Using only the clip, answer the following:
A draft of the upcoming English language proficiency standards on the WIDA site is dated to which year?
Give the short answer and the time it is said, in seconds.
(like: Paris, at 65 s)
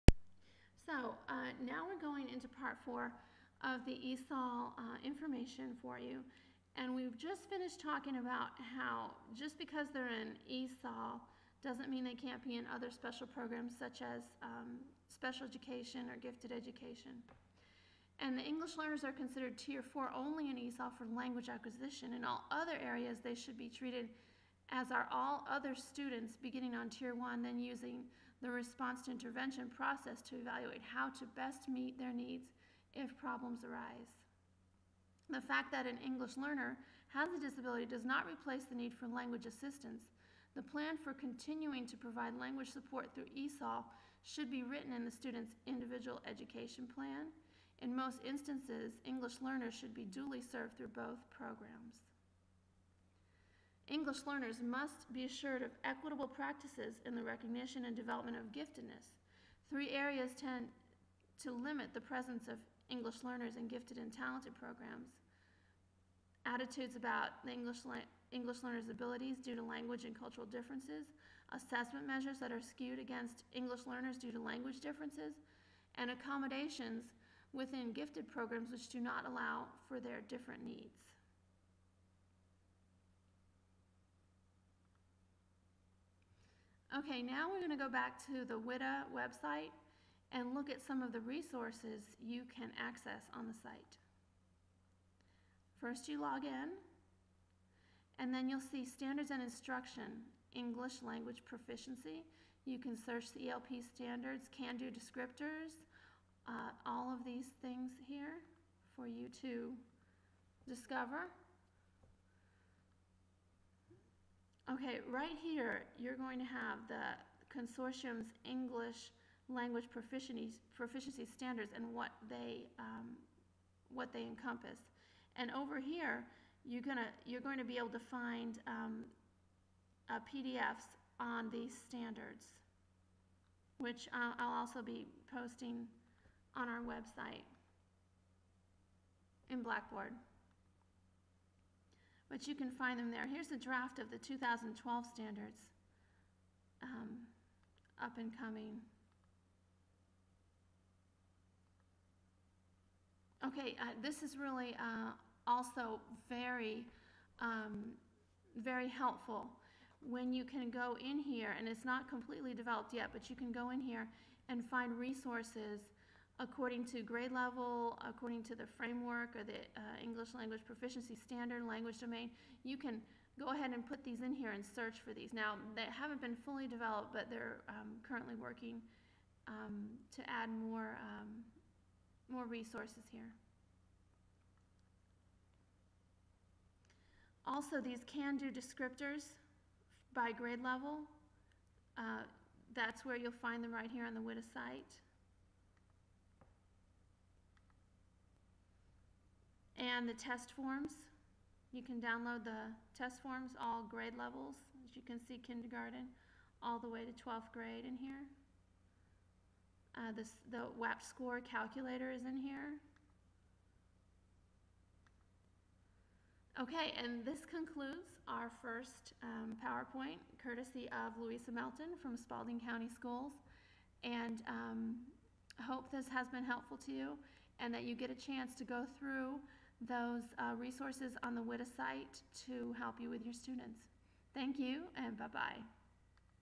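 2012, at 144 s.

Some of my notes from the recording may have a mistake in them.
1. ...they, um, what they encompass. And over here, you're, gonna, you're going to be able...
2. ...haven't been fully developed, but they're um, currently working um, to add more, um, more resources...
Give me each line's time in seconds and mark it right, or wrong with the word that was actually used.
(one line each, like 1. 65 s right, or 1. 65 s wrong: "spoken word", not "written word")
1. 122 s right
2. 175 s right.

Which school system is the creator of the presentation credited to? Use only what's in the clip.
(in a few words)
Spalding County Schools.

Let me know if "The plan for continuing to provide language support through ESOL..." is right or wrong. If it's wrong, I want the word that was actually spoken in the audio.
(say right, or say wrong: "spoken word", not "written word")
right.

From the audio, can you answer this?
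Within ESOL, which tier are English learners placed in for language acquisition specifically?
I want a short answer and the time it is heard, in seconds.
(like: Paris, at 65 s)
Tier 4, at 19 s.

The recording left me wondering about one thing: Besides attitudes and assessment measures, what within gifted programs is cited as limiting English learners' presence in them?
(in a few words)
Accommodations.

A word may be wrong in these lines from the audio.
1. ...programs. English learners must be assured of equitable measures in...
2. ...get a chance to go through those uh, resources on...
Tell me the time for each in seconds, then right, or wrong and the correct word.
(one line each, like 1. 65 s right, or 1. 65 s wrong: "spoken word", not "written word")
1. 51 s wrong: "practices", not "measures"
2. 227 s right.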